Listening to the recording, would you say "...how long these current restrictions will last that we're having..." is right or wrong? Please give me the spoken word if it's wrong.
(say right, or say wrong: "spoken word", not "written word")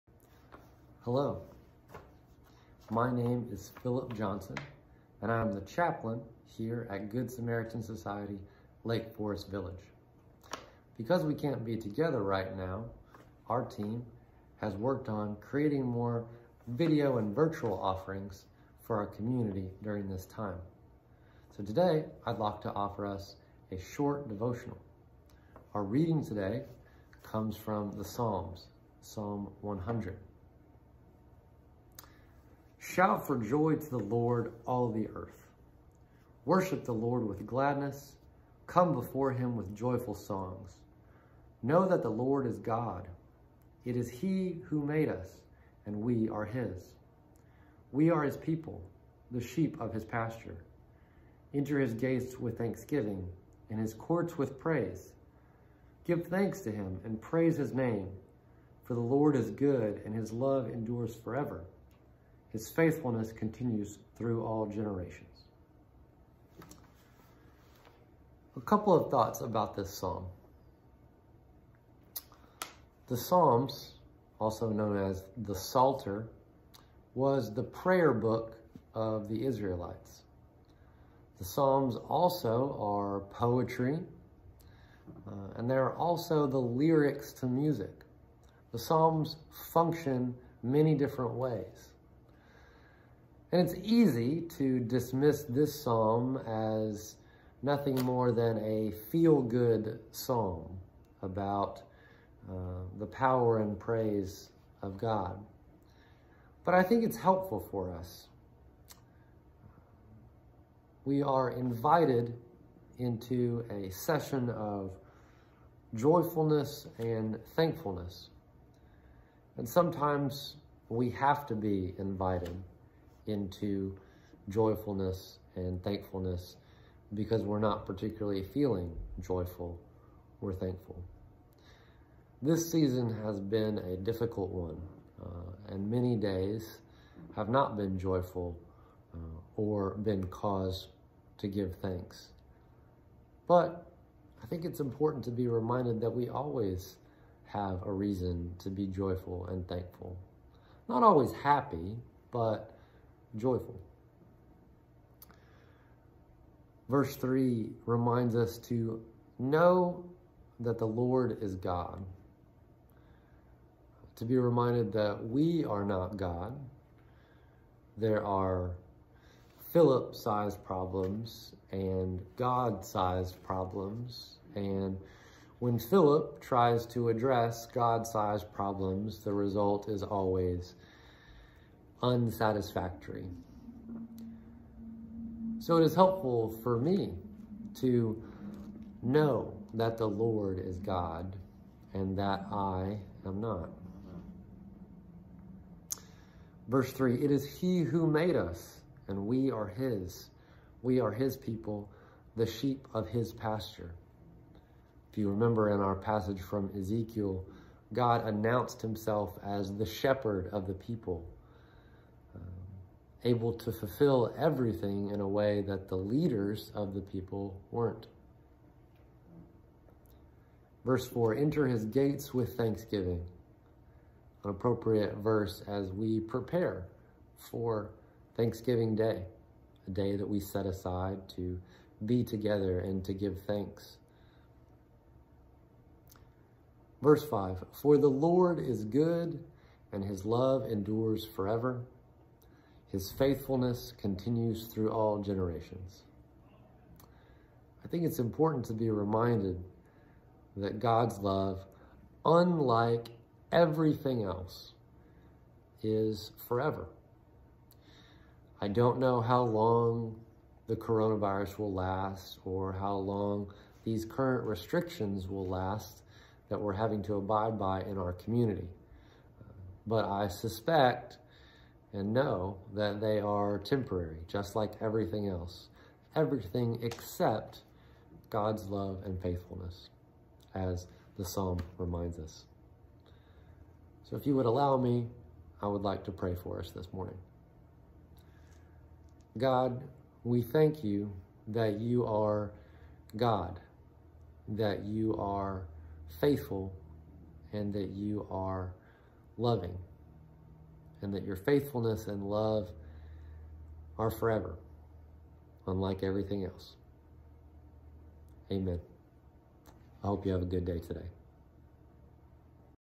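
right.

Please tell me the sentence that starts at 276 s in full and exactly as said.
Everything except God's love and faithfulness, as the psalm reminds us.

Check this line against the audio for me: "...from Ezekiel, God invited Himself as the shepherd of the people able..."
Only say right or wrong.
wrong.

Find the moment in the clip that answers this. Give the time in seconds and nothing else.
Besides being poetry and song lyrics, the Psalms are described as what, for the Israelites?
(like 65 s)
77 s.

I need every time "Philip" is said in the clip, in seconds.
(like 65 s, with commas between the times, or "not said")
3 s, 169 s, 175 s.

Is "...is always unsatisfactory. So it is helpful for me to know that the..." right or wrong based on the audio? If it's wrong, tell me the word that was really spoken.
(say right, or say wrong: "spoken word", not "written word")
right.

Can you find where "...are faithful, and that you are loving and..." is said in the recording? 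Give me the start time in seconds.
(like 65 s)
295 s.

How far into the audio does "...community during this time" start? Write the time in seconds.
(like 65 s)
19 s.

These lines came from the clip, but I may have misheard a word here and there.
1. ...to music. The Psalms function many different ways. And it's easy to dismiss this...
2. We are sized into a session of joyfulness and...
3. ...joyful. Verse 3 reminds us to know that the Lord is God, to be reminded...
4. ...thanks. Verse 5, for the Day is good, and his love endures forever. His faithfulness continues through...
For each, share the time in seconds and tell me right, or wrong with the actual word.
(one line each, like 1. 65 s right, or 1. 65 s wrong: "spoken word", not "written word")
1. 87 s right
2. 111 s wrong: "invited", not "sized"
3. 153 s right
4. 233 s wrong: "Lord", not "Day".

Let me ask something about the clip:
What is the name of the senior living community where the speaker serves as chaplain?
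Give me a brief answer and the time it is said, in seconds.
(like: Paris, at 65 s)
Lake Forest Village, at 8 s.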